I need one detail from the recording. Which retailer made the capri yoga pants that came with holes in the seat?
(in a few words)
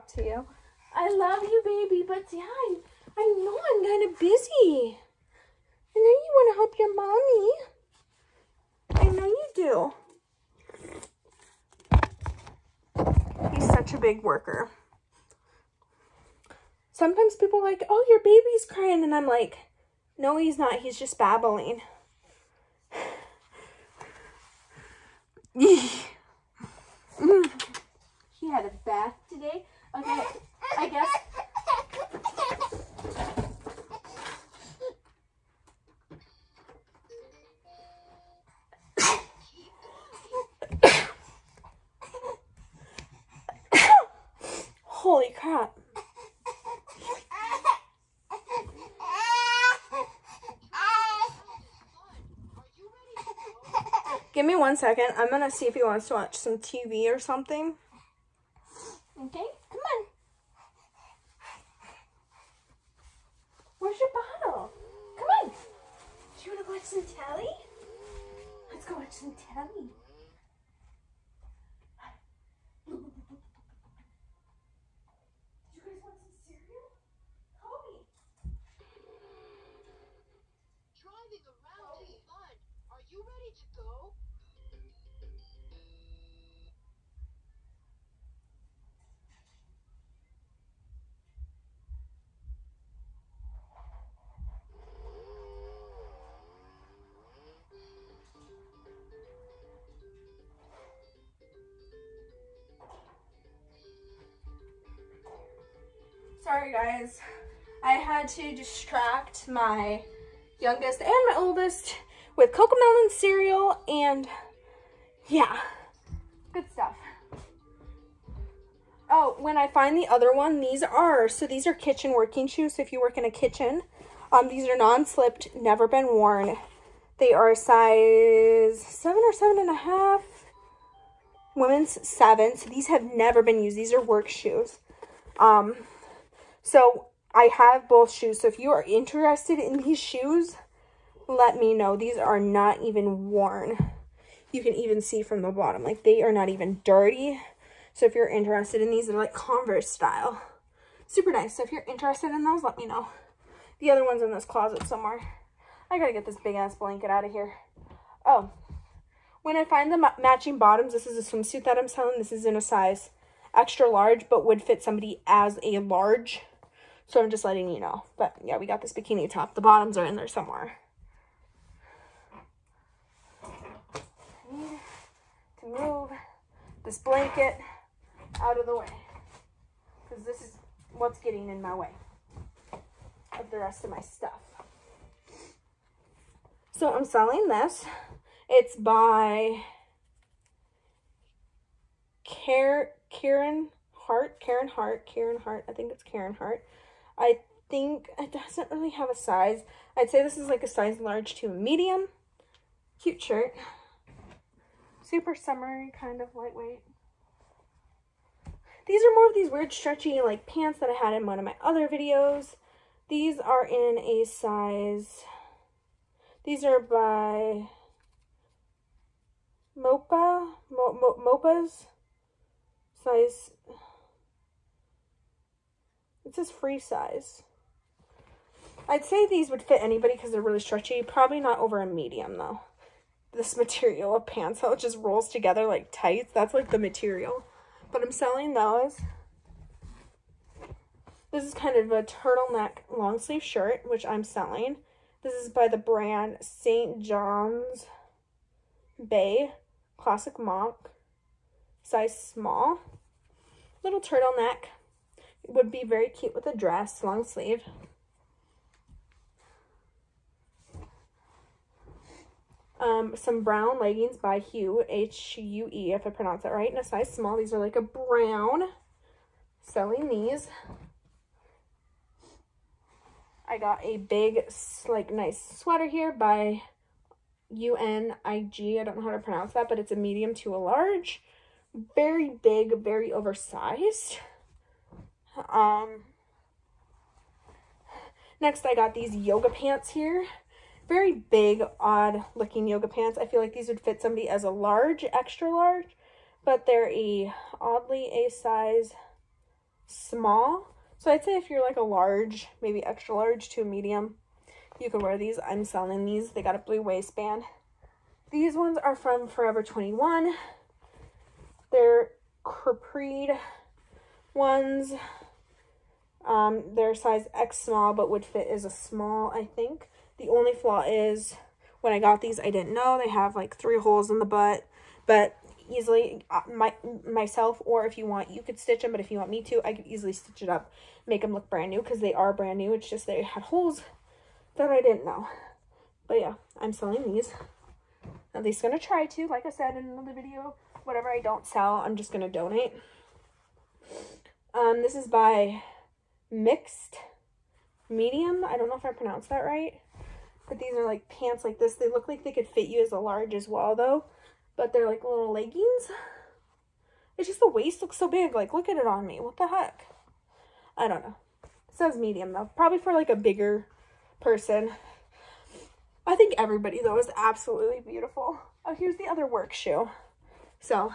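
Forever 21.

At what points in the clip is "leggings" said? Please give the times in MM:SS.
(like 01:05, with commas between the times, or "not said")
04:23, 05:55.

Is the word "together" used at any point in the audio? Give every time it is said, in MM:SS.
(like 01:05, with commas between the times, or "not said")
03:55.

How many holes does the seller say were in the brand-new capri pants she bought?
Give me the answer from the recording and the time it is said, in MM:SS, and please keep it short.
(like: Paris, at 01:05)
3, at 05:23.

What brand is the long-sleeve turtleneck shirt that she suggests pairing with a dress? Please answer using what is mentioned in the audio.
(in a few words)
St. John's Bay.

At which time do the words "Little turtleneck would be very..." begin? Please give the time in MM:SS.
04:13.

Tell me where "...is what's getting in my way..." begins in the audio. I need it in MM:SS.
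03:00.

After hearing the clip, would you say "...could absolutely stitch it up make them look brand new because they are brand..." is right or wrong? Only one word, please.
wrong.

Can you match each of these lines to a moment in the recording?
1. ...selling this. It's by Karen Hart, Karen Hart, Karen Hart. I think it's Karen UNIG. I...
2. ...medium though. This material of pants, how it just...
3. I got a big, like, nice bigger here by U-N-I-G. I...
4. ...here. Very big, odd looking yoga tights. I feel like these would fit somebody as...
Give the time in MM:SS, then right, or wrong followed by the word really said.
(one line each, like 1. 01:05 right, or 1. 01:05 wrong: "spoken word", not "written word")
1. 03:07 wrong: "Hart", not "UNIG"
2. 03:51 right
3. 04:33 wrong: "sweater", not "bigger"
4. 04:49 wrong: "pants", not "tights".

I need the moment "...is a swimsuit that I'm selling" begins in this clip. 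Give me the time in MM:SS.
02:41.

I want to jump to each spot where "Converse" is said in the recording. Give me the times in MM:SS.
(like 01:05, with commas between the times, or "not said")
02:29.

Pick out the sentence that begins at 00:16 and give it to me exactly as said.
Sometimes people like, oh, your baby's crying.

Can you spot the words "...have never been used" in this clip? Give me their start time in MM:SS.
02:12.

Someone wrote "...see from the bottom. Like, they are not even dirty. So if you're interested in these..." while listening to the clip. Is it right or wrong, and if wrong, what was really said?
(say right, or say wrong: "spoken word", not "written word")
right.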